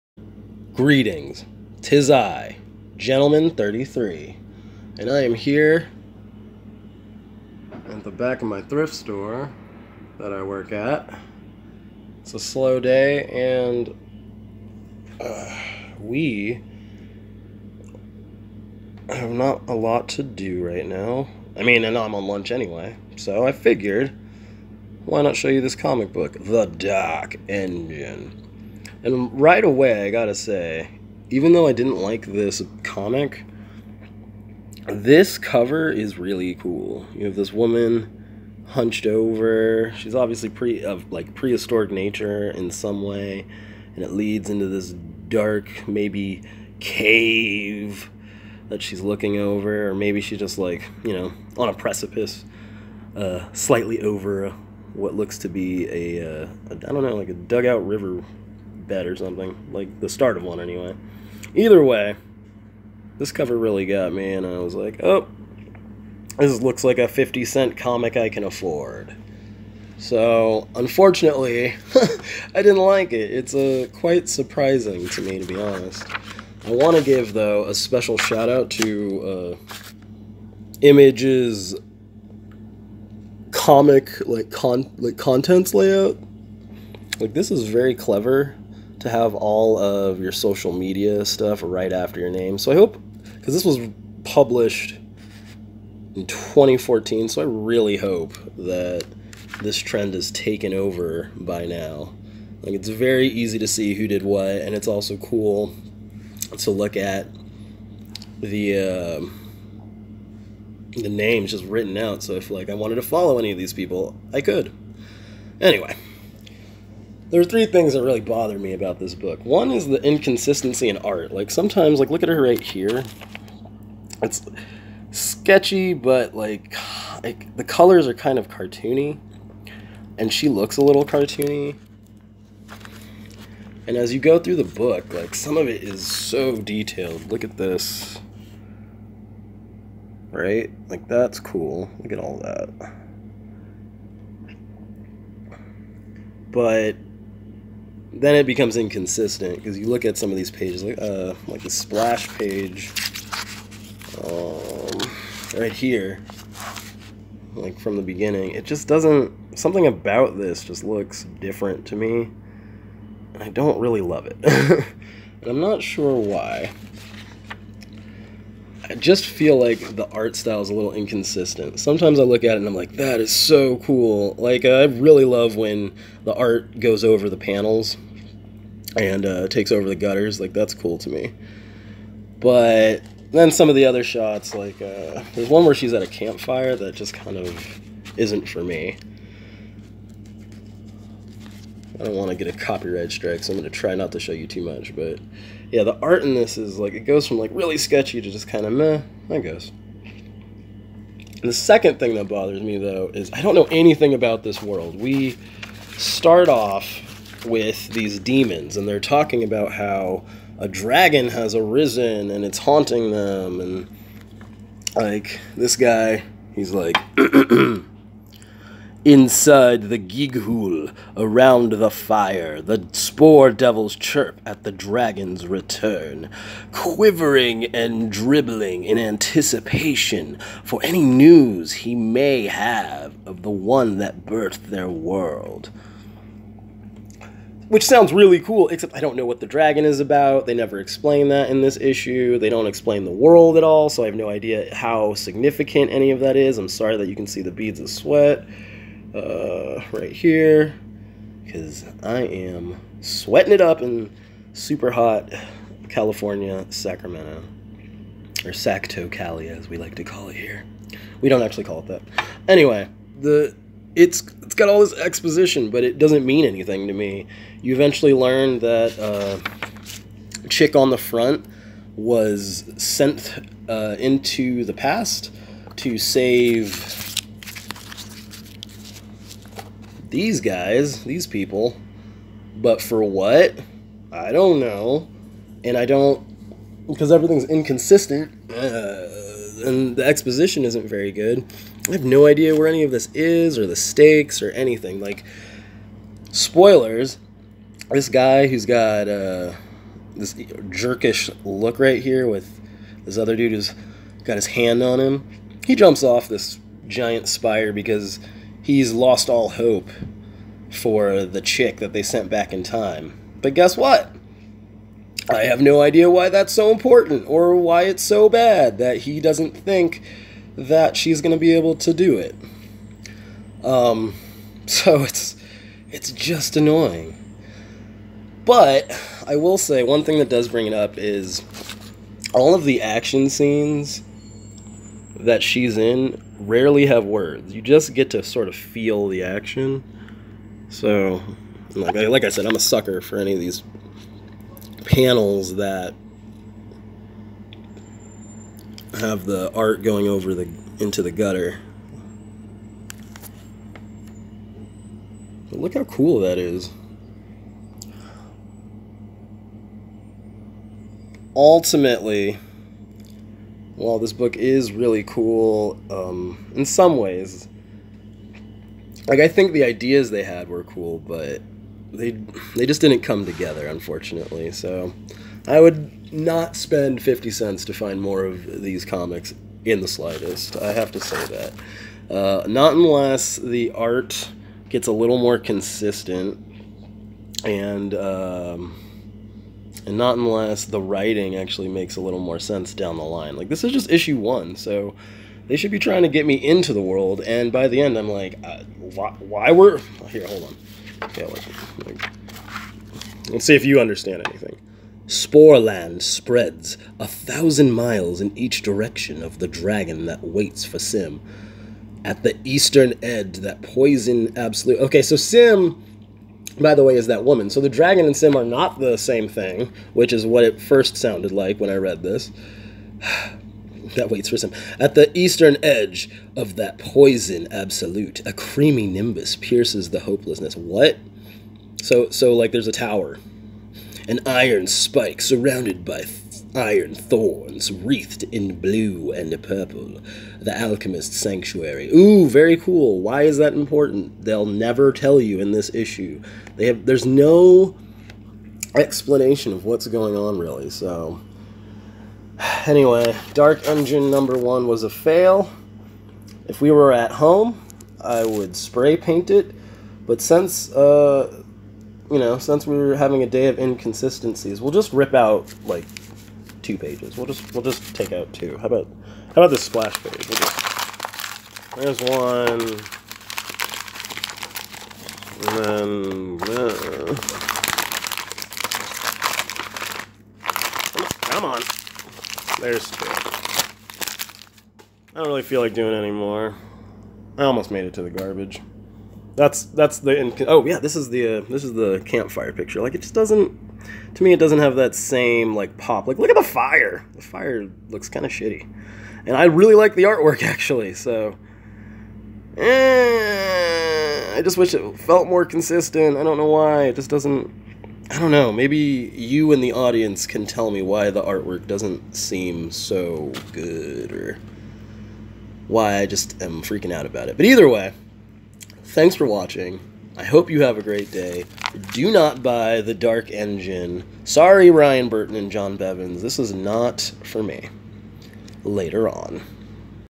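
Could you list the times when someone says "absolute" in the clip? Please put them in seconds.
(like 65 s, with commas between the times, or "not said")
414 s, 427 s.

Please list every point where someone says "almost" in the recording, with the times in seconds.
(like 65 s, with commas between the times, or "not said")
487 s.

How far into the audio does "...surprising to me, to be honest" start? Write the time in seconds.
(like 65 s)
74 s.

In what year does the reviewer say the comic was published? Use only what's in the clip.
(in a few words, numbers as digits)
2014.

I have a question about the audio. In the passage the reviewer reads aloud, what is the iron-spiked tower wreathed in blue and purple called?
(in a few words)
The Alchemist Sanctuary.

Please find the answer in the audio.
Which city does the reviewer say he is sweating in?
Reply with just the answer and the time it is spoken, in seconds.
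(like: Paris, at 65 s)
Sacramento, at 256 s.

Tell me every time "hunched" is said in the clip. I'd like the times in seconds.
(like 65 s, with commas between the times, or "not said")
38 s.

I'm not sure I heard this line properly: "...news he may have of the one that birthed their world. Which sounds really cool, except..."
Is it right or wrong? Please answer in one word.
right.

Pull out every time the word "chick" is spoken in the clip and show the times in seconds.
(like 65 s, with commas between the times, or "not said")
270 s, 311 s.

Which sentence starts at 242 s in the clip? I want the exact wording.
They don't explain the world at all, so I have no idea how significant any of that is.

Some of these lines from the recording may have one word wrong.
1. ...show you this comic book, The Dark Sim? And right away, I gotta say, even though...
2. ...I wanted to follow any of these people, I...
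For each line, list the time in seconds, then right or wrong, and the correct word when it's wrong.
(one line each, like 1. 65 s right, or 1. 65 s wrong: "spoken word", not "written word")
1. 25 s wrong: "Engine", not "Sim"
2. 112 s right.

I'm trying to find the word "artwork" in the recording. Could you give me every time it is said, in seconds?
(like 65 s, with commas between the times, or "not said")
500 s, 511 s.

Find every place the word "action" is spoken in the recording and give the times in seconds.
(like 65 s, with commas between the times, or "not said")
332 s, 339 s.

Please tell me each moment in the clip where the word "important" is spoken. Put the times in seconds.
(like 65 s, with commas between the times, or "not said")
316 s, 443 s.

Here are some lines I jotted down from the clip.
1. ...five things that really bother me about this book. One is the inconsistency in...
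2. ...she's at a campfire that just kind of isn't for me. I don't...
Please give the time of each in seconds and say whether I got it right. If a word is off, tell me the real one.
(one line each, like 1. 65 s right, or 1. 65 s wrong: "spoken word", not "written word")
1. 117 s wrong: "three", not "five"
2. 185 s right.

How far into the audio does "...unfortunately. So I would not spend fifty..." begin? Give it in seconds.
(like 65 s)
373 s.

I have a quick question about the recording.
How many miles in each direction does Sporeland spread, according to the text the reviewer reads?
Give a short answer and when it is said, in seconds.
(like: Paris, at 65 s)
1000, at 406 s.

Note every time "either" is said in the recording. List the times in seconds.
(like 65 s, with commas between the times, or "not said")
61 s, 517 s.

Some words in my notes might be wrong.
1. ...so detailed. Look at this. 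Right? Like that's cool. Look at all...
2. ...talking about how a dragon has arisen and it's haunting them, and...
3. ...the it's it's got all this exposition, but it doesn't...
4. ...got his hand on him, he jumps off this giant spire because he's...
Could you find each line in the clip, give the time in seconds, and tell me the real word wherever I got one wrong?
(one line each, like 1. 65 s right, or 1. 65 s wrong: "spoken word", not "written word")
1. 136 s right
2. 208 s right
3. 263 s right
4. 304 s right.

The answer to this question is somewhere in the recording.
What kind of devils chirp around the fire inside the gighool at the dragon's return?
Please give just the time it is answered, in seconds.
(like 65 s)
222 s.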